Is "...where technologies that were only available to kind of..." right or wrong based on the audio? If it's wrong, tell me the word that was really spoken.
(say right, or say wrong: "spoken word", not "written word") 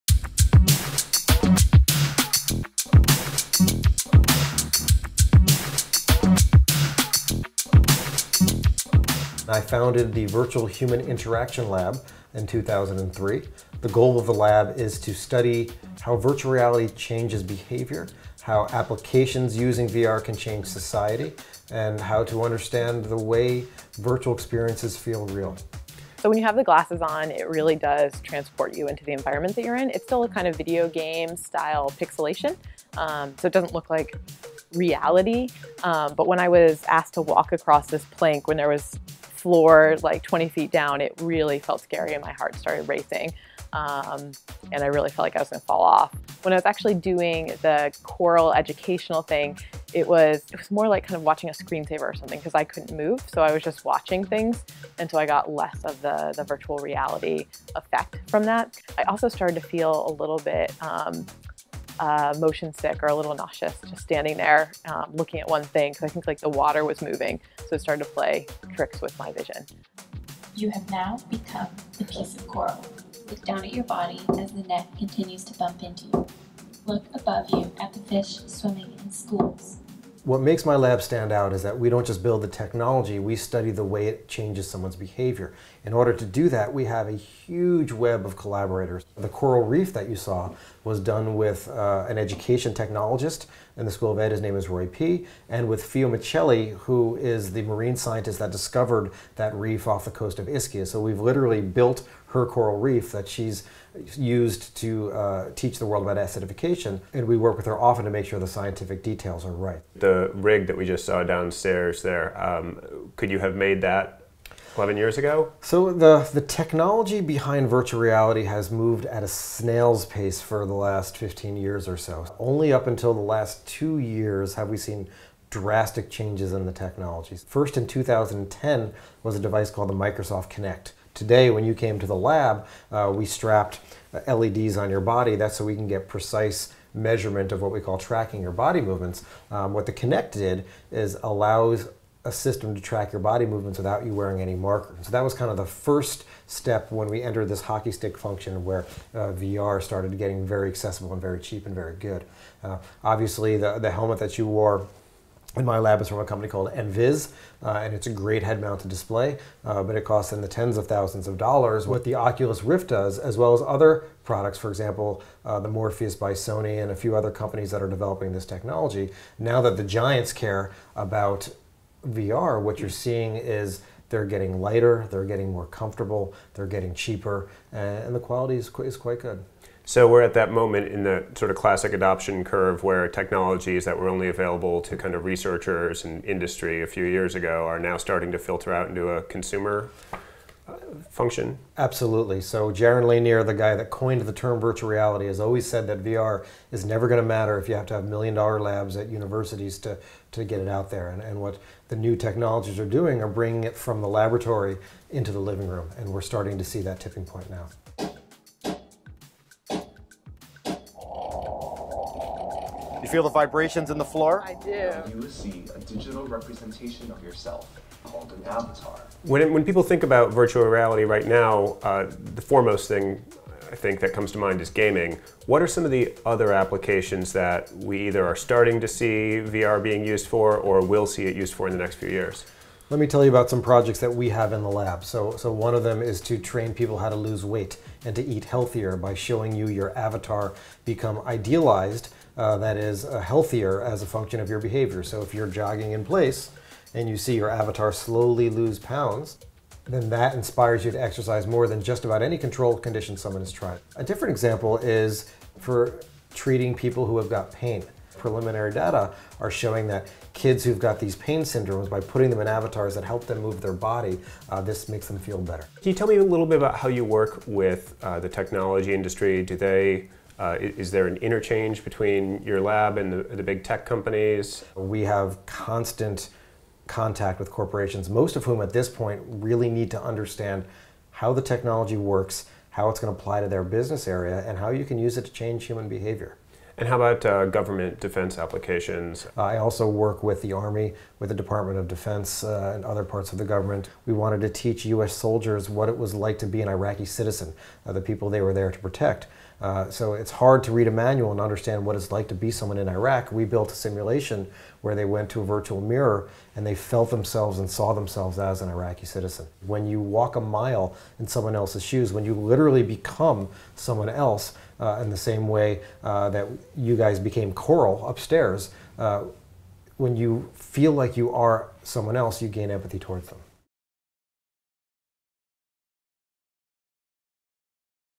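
right.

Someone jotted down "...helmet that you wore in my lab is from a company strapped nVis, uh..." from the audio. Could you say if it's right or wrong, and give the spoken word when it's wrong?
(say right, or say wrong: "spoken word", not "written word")
wrong: "called", not "strapped".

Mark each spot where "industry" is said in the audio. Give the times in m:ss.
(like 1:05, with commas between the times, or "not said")
3:06, 4:28.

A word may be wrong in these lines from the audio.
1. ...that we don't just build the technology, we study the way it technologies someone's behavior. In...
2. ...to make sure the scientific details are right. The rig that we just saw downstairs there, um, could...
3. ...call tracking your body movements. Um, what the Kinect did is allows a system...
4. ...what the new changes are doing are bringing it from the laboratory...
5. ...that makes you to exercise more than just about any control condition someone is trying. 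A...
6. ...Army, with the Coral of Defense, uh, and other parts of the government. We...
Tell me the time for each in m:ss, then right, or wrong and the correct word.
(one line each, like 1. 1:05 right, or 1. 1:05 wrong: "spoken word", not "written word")
1. 1:21 wrong: "changes", not "technologies"
2. 1:48 right
3. 2:17 right
4. 3:21 wrong: "technologies", not "changes"
5. 4:10 wrong: "inspires", not "makes"
6. 4:50 wrong: "Department", not "Coral".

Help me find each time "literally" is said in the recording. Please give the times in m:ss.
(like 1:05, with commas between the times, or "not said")
1:41, 5:12.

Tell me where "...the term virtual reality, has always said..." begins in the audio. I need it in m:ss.
3:14.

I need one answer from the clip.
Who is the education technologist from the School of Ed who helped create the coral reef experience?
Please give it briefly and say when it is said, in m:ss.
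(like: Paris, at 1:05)
Roy Pea, at 1:34.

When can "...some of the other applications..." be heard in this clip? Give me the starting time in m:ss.
3:45.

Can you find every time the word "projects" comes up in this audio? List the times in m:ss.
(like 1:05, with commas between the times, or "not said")
3:53.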